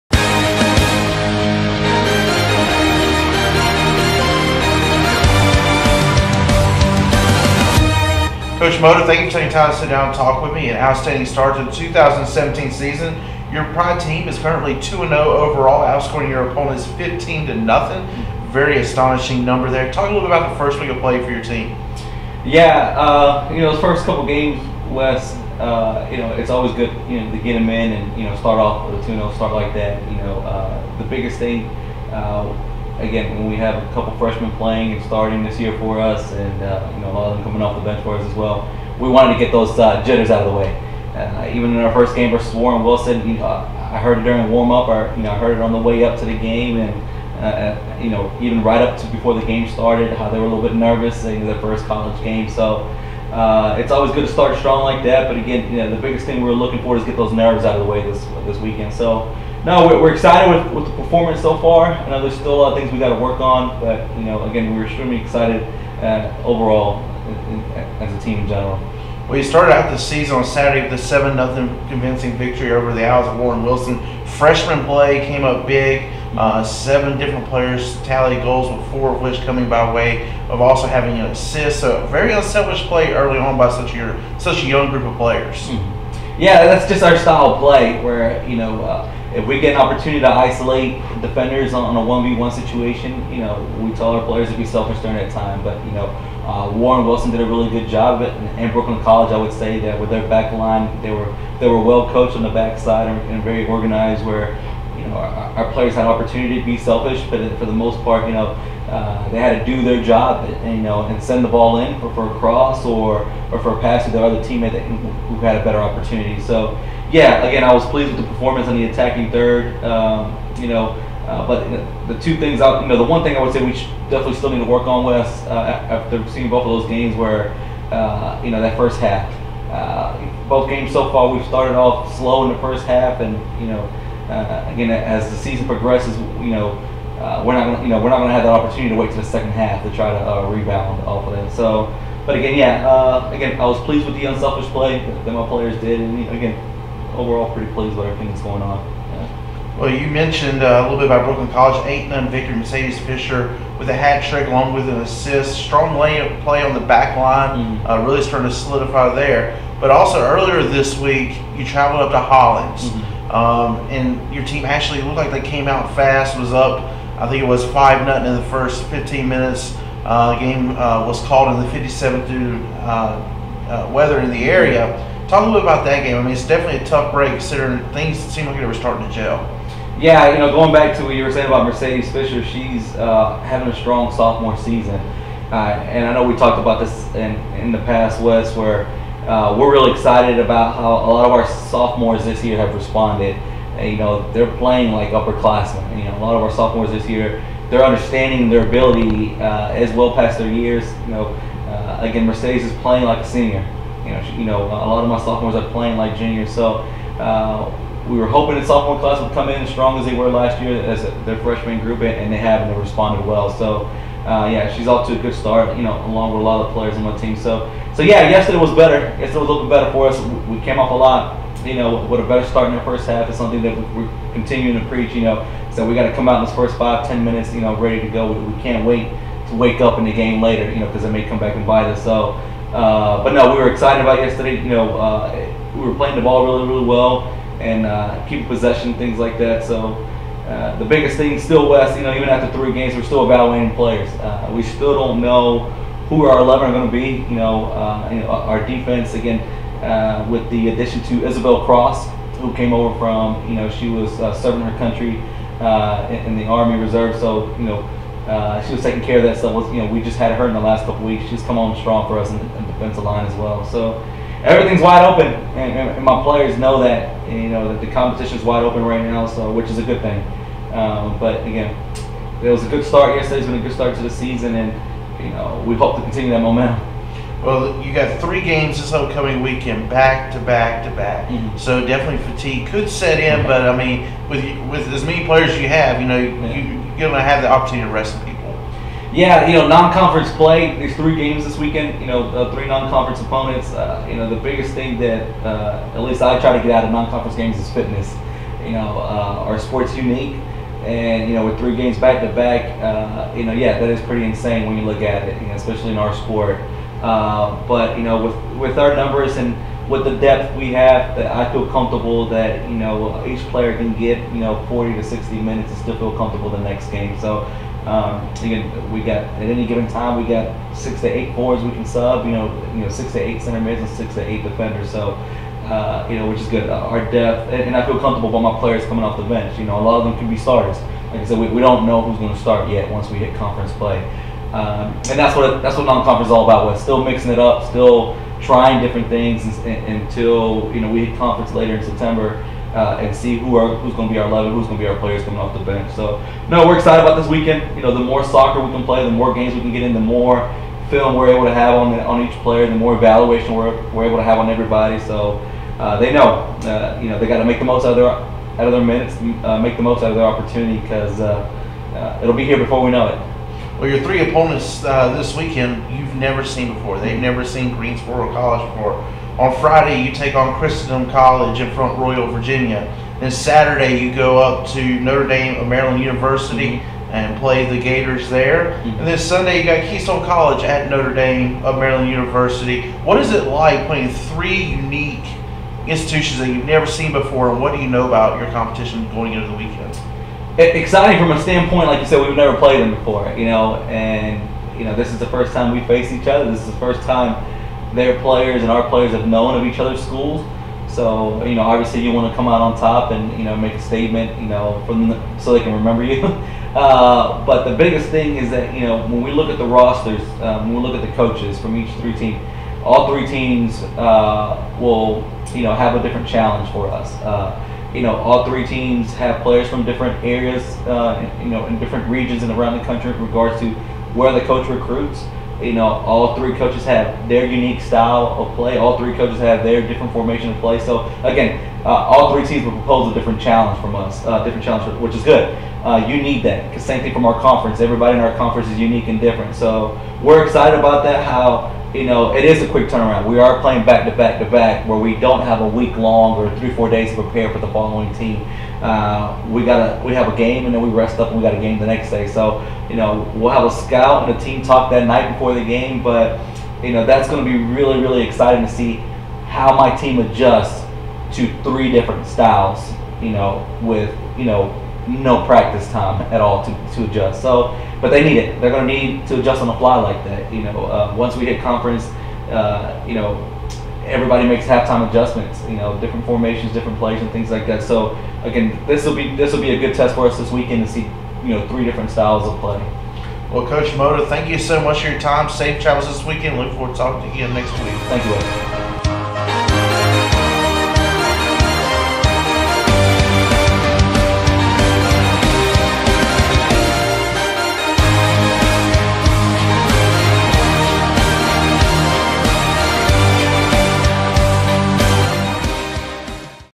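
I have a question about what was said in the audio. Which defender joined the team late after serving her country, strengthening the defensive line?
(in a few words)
Isabel Cross.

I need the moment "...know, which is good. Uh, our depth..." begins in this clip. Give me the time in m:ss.
5:26.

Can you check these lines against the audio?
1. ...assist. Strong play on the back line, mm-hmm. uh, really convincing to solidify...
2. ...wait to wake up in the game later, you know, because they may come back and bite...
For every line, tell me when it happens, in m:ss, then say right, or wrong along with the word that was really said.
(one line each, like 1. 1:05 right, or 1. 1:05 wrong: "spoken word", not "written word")
1. 2:35 wrong: "starting", not "convincing"
2. 3:48 right.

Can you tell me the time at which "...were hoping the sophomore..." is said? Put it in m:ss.
3:28.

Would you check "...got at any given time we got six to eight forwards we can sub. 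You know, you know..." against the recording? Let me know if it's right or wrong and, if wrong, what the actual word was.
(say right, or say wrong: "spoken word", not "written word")
right.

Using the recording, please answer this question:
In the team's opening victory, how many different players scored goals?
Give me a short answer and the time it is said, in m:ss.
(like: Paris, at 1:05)
7, at 1:16.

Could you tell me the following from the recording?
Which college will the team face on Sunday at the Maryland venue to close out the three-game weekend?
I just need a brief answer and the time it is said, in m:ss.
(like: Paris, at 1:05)
Keystone College, at 6:19.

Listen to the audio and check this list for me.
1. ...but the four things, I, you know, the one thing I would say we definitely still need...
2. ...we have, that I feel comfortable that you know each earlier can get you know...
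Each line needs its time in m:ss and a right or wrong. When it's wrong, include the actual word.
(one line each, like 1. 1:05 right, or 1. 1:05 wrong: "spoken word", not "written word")
1. 2:01 wrong: "two", not "four"
2. 5:10 wrong: "player", not "earlier".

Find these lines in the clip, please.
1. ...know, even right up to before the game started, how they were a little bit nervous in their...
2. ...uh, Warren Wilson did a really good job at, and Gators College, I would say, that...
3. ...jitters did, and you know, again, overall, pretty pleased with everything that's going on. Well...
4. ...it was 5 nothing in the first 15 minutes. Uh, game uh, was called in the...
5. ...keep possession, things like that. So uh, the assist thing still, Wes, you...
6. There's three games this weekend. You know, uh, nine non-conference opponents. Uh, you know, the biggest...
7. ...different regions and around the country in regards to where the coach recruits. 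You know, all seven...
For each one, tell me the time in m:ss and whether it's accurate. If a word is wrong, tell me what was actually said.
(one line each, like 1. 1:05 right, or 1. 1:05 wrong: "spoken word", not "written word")
1. 0:48 right
2. 1:36 wrong: "Brooklyn", not "Gators"
3. 2:25 wrong: "players", not "jitters"
4. 2:47 right
5. 3:58 wrong: "biggest", not "assist"
6. 4:50 wrong: "three", not "nine"
7. 7:01 wrong: "three", not "seven".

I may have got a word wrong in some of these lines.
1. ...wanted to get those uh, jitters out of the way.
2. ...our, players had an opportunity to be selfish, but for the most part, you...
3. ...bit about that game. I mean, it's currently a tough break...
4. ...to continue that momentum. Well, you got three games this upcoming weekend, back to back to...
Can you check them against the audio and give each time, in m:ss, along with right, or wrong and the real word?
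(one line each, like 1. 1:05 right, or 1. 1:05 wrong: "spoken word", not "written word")
1. 0:39 right
2. 1:45 right
3. 2:55 wrong: "definitely", not "currently"
4. 4:35 right.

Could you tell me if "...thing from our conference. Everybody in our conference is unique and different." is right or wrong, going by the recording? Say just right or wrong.
right.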